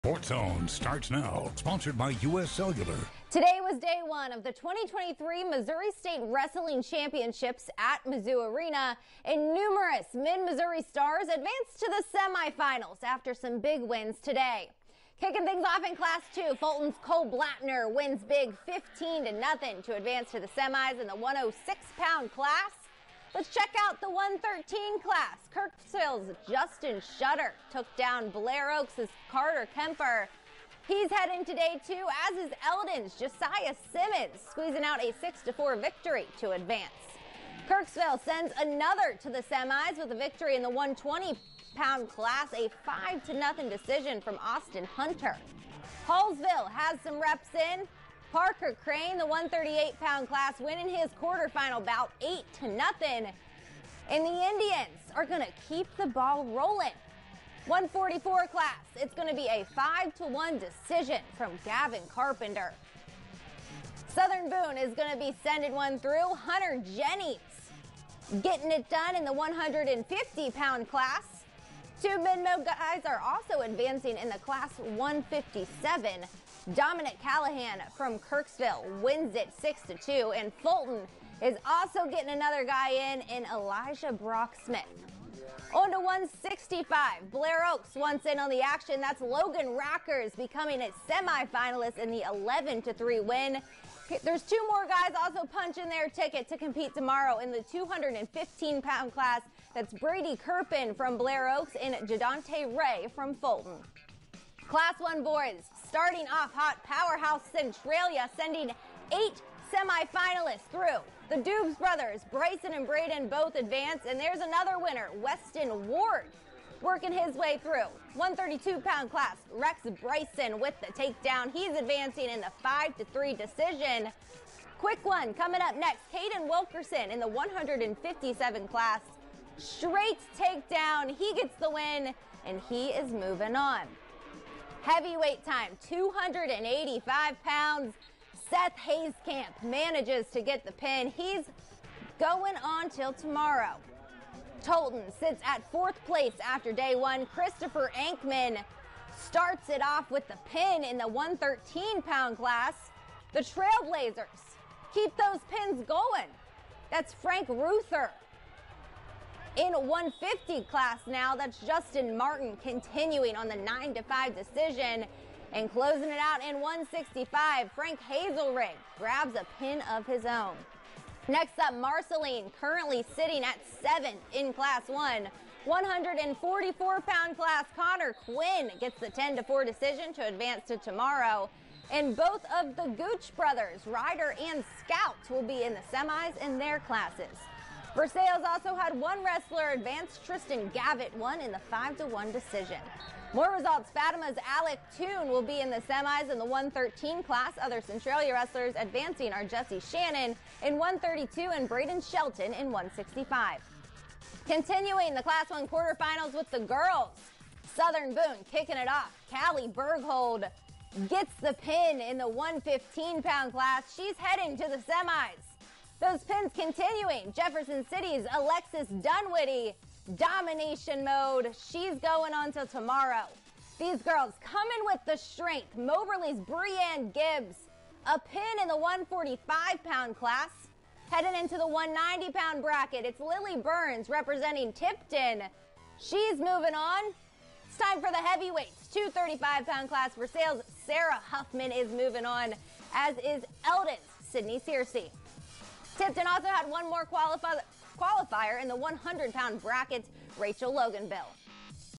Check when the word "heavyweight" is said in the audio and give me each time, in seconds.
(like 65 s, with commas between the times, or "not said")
134 s, 238 s.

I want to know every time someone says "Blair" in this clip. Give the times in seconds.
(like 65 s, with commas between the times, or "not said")
28 s, 87 s, 101 s.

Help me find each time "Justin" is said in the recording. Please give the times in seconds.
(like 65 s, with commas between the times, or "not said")
26 s, 161 s.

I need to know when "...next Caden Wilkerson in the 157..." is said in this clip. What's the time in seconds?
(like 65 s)
125 s.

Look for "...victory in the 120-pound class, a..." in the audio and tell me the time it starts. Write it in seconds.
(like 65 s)
40 s.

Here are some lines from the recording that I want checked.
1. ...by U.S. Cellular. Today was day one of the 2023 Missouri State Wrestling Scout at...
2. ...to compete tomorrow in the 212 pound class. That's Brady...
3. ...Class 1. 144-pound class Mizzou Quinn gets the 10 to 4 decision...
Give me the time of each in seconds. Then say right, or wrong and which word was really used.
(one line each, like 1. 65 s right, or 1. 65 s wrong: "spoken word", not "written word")
1. 1 s wrong: "Championships", not "Scout"
2. 96 s wrong: "215", not "212"
3. 174 s wrong: "Connor", not "Mizzou".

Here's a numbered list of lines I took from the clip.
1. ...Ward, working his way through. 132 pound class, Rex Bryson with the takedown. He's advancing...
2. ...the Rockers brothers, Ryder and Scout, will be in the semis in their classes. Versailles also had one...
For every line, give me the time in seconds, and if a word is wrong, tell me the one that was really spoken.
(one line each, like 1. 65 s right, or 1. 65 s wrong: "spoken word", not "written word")
1. 115 s right
2. 182 s wrong: "Gooch", not "Rockers".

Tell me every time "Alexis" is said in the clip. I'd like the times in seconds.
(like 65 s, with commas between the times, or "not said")
218 s.